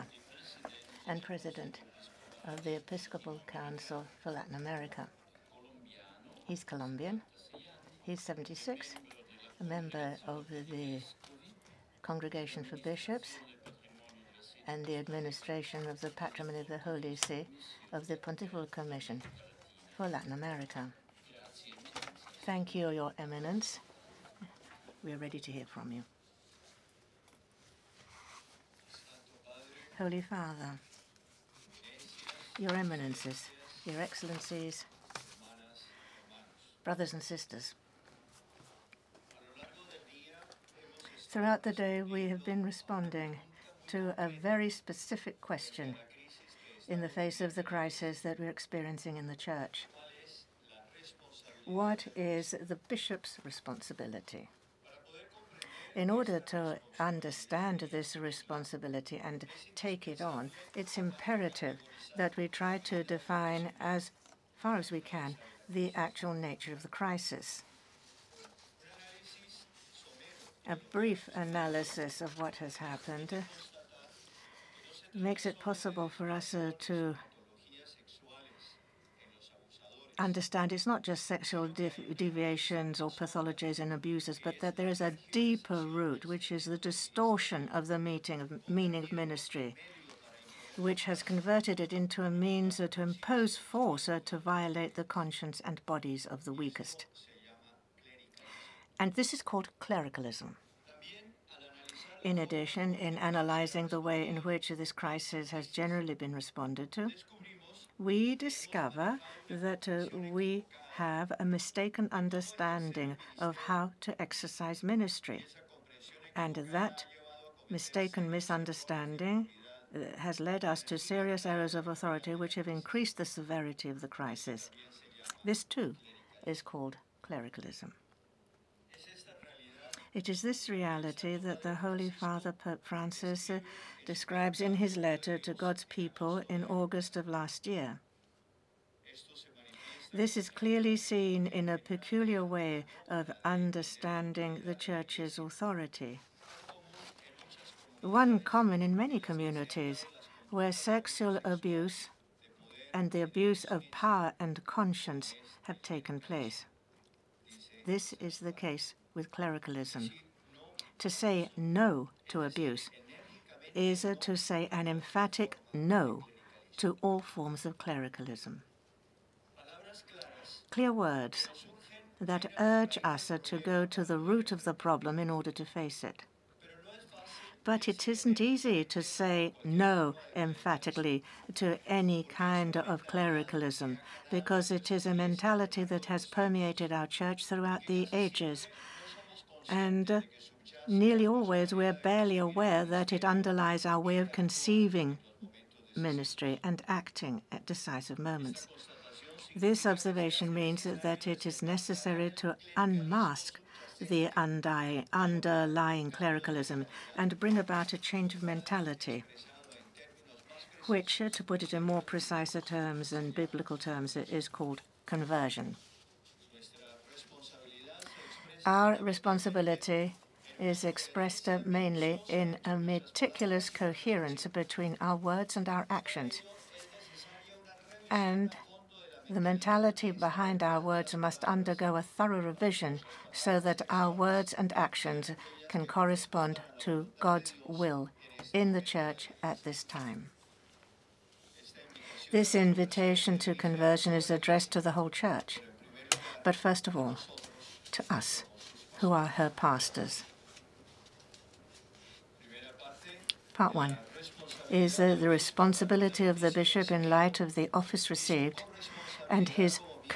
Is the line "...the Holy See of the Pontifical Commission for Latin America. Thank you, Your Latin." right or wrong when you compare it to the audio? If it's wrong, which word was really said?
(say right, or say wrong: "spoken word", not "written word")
wrong: "Eminence", not "Latin".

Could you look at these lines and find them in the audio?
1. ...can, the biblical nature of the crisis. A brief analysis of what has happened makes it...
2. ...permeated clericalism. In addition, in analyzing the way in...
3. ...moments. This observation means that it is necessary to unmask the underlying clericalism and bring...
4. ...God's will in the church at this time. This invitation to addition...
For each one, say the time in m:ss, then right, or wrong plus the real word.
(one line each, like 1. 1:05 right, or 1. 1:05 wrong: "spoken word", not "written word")
1. 1:05 wrong: "actual", not "biblical"
2. 1:39 wrong: "called", not "permeated"
3. 3:18 right
4. 3:57 wrong: "conversion", not "addition".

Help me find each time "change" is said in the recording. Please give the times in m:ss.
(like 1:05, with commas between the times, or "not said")
3:27.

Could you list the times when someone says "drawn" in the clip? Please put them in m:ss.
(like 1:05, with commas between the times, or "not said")
not said.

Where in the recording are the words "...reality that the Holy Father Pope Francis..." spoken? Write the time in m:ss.
2:10.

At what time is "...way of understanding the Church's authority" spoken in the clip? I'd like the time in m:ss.
2:22.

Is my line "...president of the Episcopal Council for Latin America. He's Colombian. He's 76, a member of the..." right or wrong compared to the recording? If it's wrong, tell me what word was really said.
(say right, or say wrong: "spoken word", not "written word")
right.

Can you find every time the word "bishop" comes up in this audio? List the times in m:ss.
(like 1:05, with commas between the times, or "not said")
0:12, 0:52, 4:16.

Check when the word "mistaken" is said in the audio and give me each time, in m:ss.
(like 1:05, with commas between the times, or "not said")
1:51, 1:57.